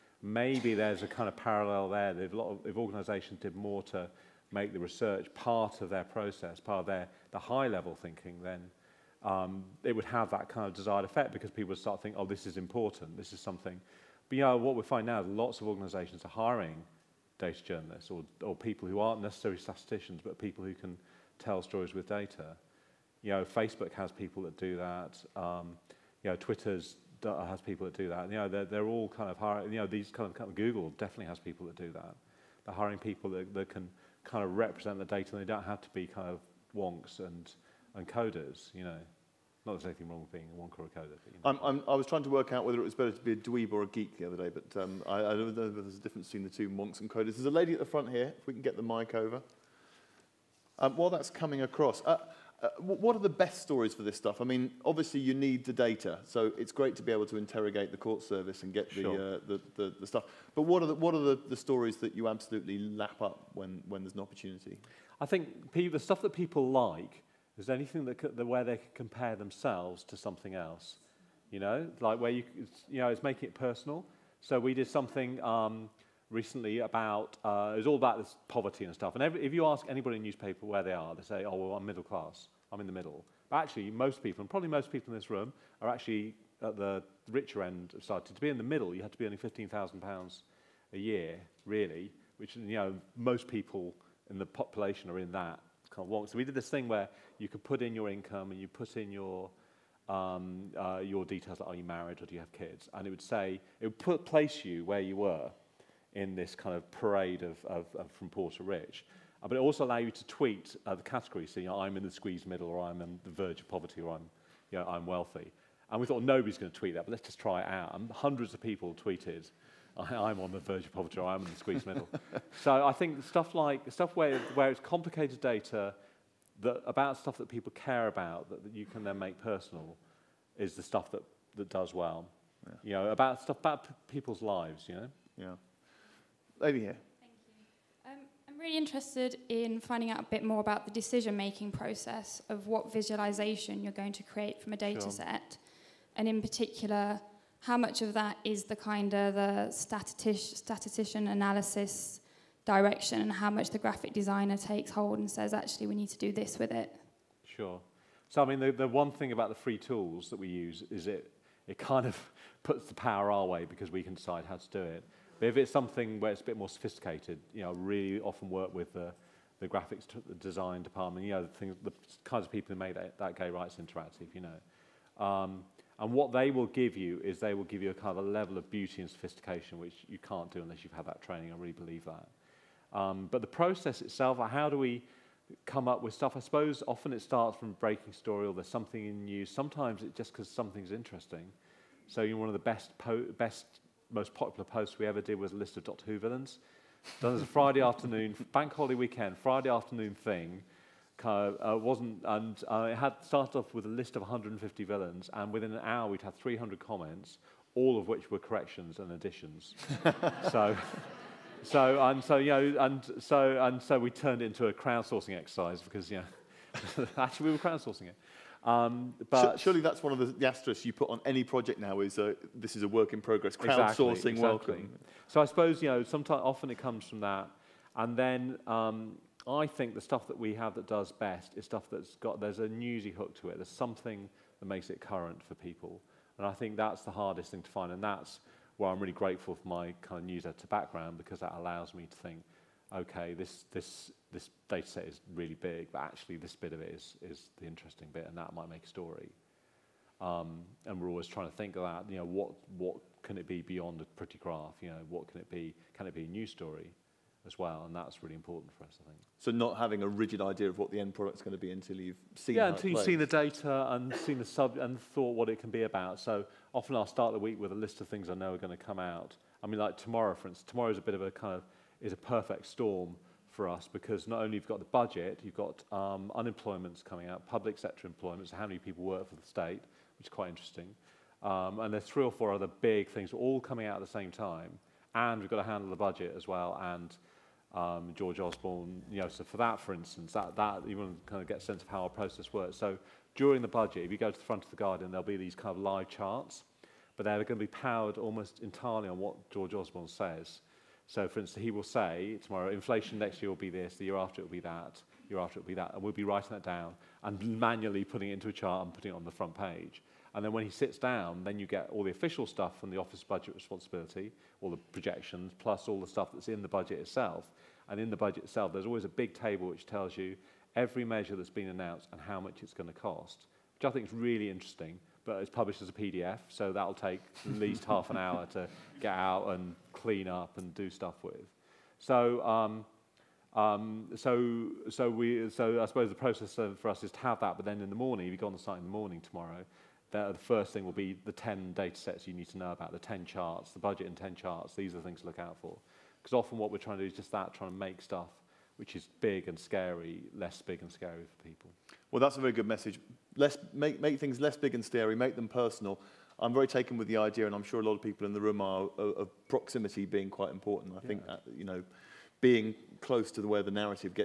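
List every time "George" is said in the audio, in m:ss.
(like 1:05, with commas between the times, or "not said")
4:48, 4:59.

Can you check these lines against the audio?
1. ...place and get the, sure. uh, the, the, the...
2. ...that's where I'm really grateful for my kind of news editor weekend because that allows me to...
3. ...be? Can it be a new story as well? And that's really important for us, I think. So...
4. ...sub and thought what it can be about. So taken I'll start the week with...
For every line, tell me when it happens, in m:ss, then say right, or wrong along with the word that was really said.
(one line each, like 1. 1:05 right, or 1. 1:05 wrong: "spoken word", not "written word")
1. 0:58 wrong: "service", not "place"
2. 3:58 wrong: "background", not "weekend"
3. 4:15 right
4. 4:24 wrong: "often", not "taken".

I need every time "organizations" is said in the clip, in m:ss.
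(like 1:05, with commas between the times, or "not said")
0:02, 0:15.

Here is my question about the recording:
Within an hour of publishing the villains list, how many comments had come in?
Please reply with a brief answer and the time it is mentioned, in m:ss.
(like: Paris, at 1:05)
300, at 3:26.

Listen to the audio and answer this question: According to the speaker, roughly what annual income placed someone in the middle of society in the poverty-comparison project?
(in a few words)
£15,000.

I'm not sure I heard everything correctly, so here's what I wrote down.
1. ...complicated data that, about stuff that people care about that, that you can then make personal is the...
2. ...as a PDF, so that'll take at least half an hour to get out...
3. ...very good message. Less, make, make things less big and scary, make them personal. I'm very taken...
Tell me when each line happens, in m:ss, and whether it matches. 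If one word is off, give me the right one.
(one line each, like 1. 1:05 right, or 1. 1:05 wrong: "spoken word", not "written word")
1. 2:04 right
2. 5:25 right
3. 5:52 right.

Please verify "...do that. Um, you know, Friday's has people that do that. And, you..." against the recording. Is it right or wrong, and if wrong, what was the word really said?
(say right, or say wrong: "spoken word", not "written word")
wrong: "Twitter", not "Friday".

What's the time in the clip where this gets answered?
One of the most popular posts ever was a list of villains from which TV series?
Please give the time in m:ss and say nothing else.
3:15.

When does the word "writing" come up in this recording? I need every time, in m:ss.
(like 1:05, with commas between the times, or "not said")
5:06.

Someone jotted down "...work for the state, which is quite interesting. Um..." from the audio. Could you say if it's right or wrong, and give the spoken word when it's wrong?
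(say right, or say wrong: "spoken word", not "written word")
right.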